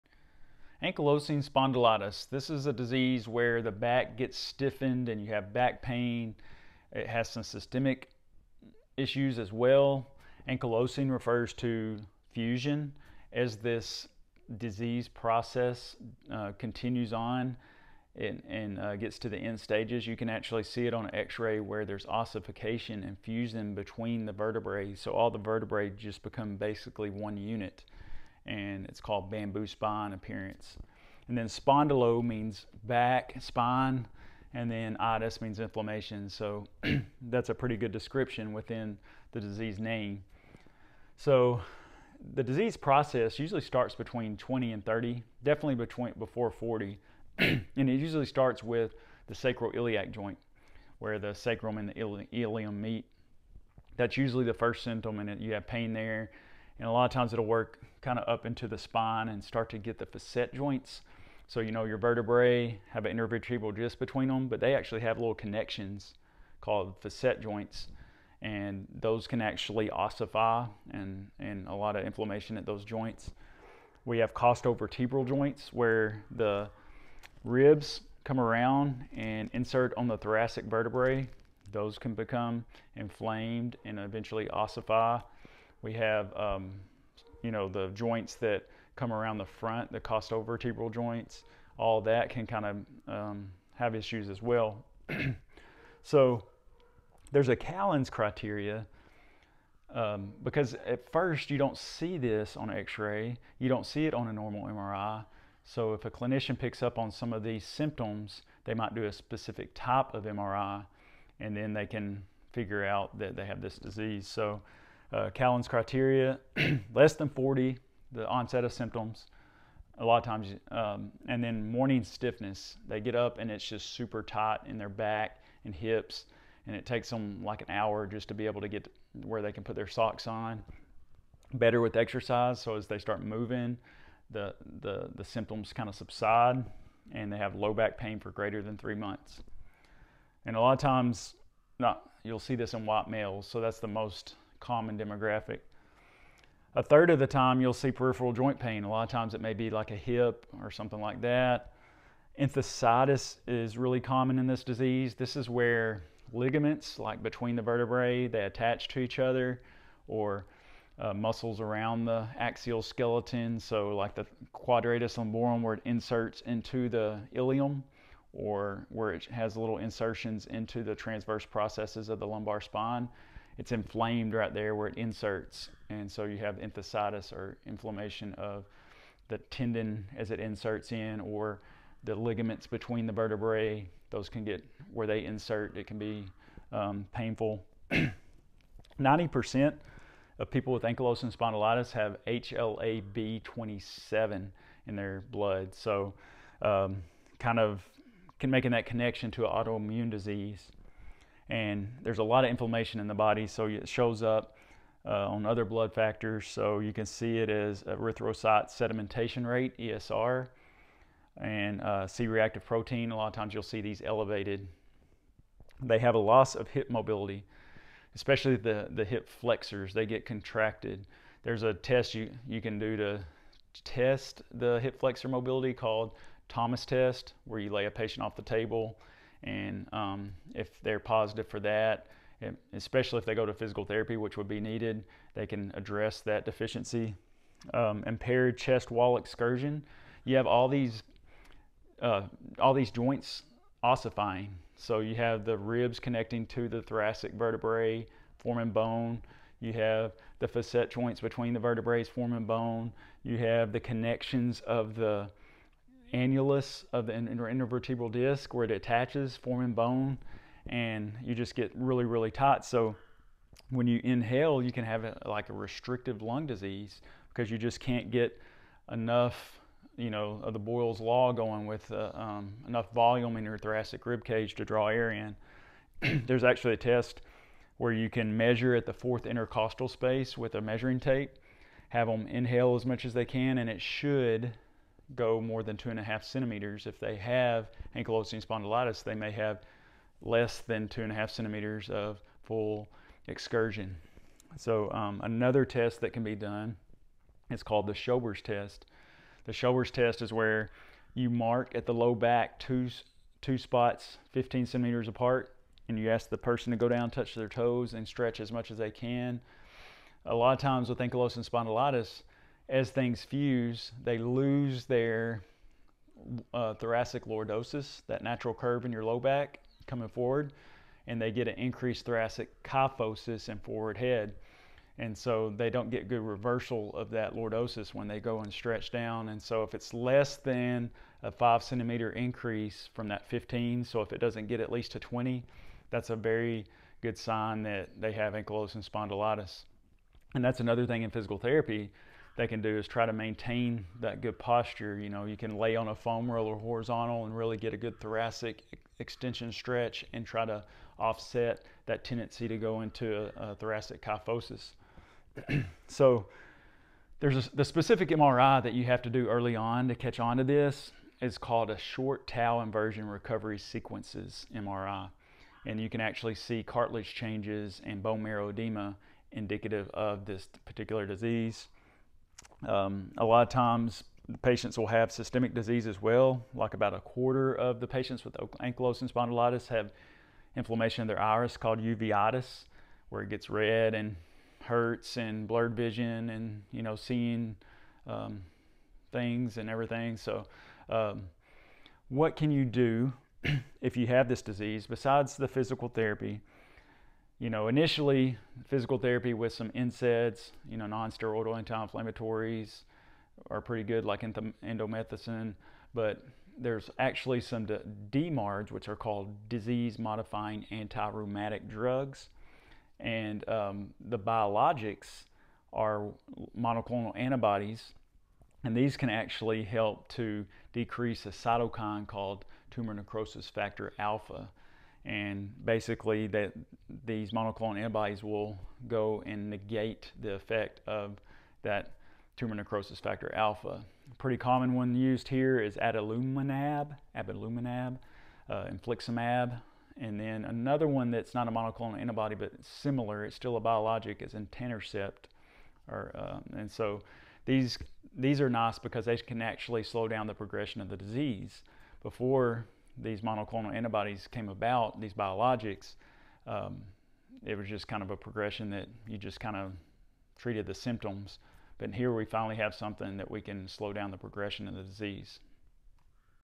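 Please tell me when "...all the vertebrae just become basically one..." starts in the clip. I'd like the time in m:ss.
0:25.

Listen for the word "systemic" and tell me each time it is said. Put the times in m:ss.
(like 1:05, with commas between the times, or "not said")
0:07, 6:15.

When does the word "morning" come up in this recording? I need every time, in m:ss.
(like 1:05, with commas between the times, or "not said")
2:01.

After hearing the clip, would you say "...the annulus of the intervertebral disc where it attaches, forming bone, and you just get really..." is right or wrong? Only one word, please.
right.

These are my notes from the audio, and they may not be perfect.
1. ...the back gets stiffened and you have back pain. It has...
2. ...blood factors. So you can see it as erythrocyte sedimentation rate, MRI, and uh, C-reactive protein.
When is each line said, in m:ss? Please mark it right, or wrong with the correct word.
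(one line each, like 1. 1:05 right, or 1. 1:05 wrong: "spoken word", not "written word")
1. 0:03 right
2. 3:25 wrong: "ESR", not "MRI".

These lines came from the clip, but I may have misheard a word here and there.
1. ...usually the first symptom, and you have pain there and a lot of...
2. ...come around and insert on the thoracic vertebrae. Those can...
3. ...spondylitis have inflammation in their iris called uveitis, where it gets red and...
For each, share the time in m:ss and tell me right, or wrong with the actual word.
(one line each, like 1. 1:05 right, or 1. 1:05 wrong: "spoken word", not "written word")
1. 0:54 right
2. 1:18 right
3. 6:19 right.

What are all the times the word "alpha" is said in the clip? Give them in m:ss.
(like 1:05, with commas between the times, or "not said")
7:03, 7:13.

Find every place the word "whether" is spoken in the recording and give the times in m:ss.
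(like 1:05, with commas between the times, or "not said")
not said.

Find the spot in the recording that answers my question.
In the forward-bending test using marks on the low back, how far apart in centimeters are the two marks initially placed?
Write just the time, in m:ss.
5:04.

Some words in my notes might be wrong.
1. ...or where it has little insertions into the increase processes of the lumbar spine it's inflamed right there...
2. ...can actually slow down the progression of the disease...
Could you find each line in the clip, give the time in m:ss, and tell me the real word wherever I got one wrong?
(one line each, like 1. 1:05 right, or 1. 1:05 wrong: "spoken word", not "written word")
1. 2:48 wrong: "transverse", not "increase"
2. 7:29 right.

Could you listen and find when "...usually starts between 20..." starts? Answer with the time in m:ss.
0:43.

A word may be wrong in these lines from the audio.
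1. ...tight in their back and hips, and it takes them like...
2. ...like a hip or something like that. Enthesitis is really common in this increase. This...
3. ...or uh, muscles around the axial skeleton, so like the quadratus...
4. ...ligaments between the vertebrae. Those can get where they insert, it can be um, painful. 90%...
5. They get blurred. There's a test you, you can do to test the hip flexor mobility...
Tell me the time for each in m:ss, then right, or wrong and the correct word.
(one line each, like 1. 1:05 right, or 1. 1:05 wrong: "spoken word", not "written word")
1. 2:04 right
2. 2:29 wrong: "disease", not "increase"
3. 2:40 right
4. 3:02 right
5. 3:39 wrong: "contracted", not "blurred".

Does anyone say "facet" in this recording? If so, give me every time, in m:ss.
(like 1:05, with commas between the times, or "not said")
1:00, 1:06, 4:10.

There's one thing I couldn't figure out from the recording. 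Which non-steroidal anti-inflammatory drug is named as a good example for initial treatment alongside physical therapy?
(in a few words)
Indomethacin.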